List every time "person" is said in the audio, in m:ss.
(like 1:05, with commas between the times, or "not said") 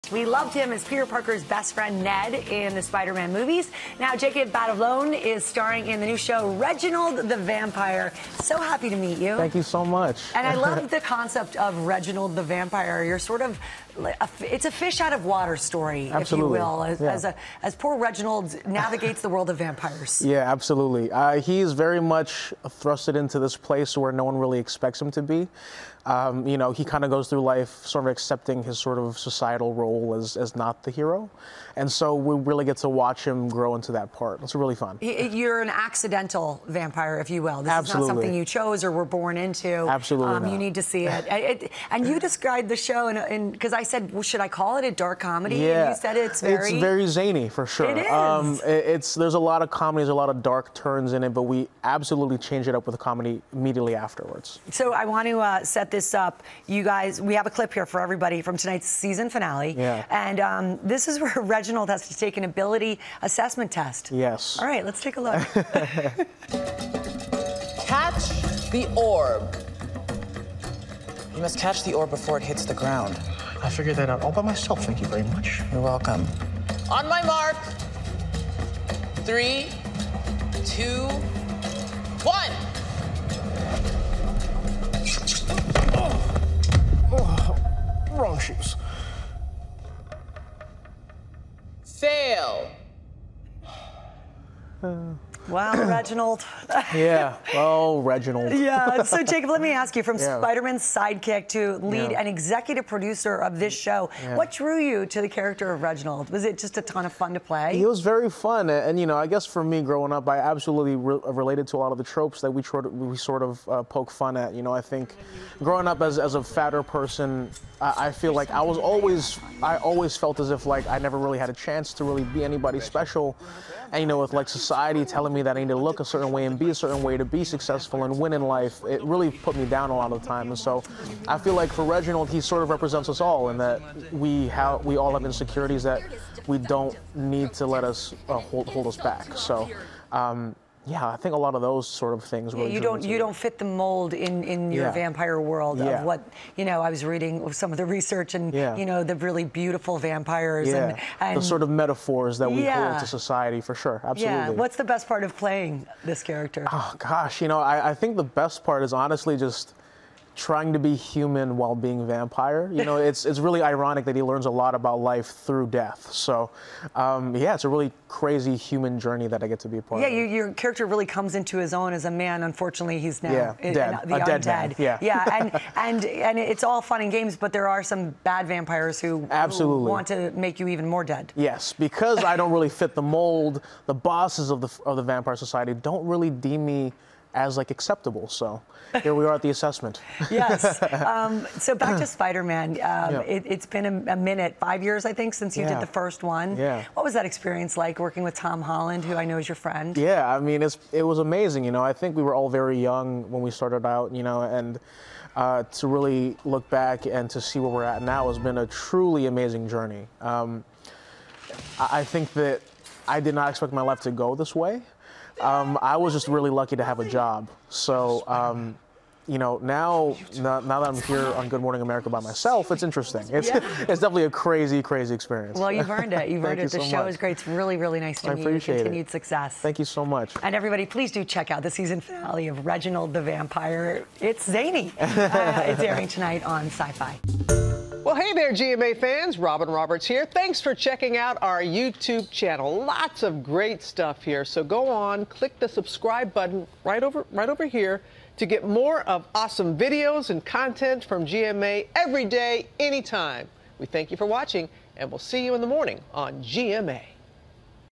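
1:56.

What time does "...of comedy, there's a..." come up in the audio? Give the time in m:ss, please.
0:49.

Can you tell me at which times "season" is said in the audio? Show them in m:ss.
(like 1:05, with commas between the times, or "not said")
0:58, 3:51.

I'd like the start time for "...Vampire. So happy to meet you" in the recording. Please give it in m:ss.
0:07.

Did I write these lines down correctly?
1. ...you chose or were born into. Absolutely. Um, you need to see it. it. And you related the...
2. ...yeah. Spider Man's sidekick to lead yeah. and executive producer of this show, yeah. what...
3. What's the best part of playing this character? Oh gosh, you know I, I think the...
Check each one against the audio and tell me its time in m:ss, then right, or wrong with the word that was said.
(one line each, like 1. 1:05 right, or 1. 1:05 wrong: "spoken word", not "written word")
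1. 0:38 wrong: "described", not "related"
2. 1:40 right
3. 2:34 right.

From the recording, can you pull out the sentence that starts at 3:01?
Yes, because I don't really fit the mold.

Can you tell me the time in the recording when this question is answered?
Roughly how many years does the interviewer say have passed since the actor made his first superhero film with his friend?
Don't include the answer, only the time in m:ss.
3:14.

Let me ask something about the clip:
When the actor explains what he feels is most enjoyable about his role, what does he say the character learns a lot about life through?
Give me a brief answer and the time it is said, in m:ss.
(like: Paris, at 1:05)
death, at 2:45.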